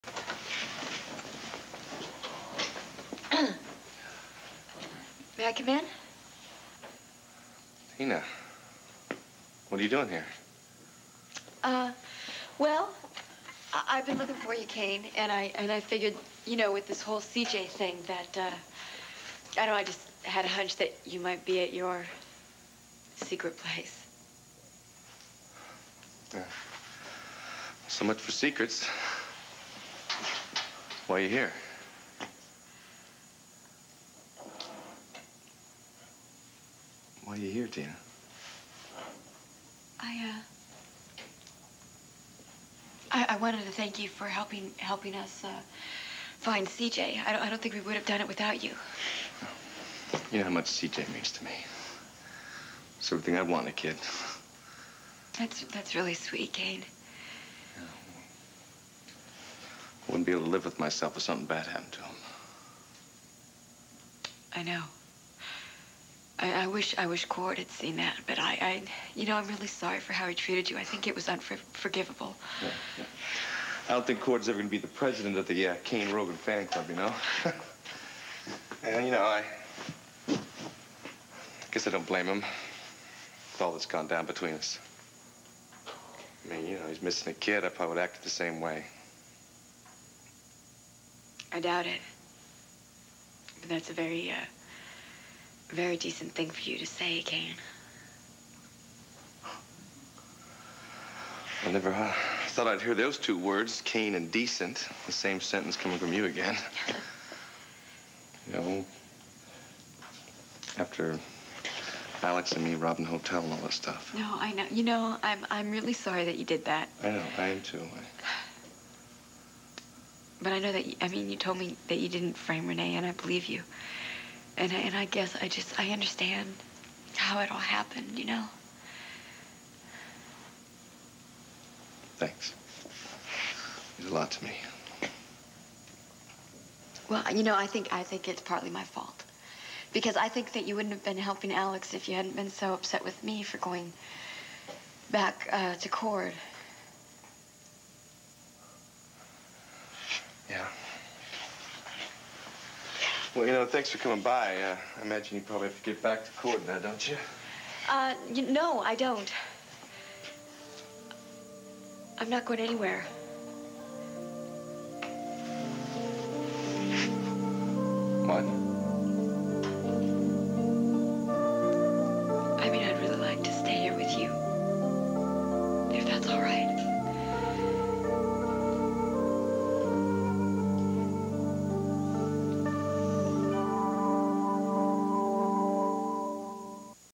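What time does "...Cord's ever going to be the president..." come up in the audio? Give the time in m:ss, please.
1:14.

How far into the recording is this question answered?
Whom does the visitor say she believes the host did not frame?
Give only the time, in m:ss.
2:02.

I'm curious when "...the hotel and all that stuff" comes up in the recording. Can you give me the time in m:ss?
1:53.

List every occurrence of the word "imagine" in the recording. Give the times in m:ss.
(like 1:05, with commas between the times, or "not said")
2:35.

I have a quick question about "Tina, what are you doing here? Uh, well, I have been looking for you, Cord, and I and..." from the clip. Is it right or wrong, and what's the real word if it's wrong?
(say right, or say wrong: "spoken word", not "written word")
wrong: "Cain", not "Cord".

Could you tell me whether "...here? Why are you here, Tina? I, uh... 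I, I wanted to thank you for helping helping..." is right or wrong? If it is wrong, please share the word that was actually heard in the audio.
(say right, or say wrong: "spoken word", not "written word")
right.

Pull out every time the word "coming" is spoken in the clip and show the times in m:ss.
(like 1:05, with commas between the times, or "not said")
1:45, 2:33.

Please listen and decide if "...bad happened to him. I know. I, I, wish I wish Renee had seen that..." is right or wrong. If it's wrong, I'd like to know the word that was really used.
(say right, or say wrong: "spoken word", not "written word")
wrong: "Cord", not "Renee".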